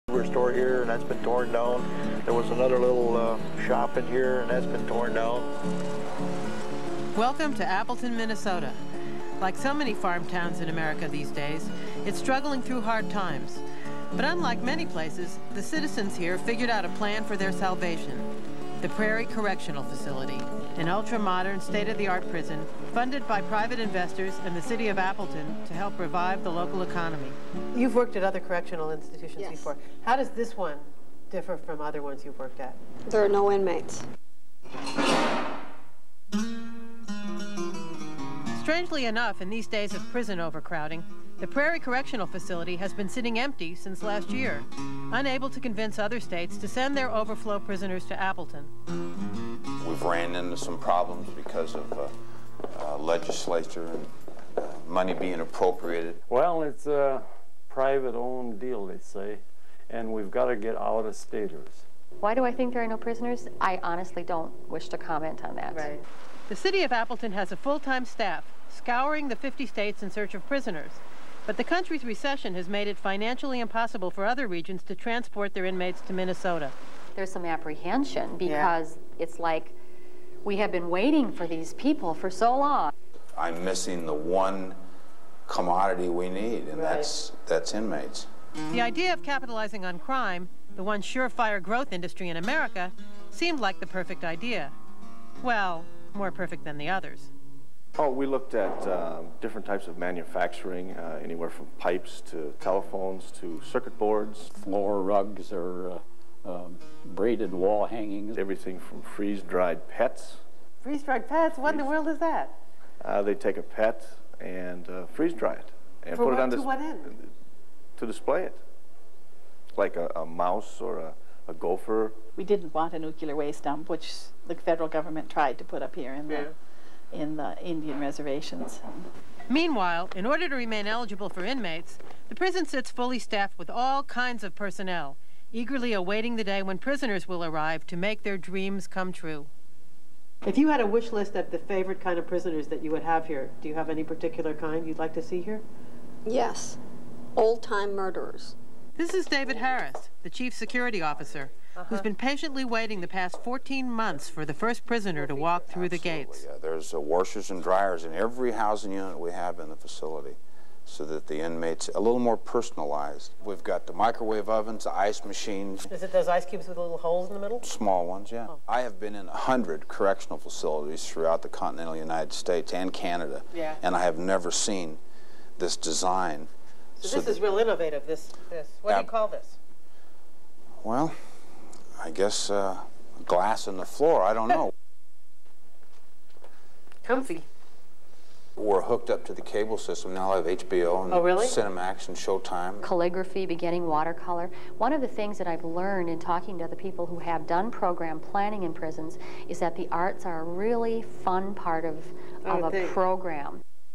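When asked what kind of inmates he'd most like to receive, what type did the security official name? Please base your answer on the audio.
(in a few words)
Old-time murderers.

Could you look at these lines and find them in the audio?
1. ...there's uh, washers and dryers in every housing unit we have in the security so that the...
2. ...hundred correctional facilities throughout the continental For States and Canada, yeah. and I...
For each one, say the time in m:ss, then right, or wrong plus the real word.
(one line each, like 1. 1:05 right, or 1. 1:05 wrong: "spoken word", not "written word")
1. 2:36 wrong: "facility", not "security"
2. 2:49 wrong: "United", not "For".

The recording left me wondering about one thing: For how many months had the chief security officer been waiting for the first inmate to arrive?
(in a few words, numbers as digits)
14.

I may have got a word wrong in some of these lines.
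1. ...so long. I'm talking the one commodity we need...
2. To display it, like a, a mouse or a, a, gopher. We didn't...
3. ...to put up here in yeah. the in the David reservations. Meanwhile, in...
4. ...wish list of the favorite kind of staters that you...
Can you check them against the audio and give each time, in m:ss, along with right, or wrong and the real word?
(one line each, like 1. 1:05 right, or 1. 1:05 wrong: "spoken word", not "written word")
1. 1:22 wrong: "missing", not "talking"
2. 1:57 right
3. 2:05 wrong: "Indian", not "David"
4. 2:20 wrong: "prisoners", not "staters".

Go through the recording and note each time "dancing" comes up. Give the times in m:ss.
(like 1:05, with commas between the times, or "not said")
not said.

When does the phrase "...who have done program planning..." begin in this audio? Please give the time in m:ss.
3:17.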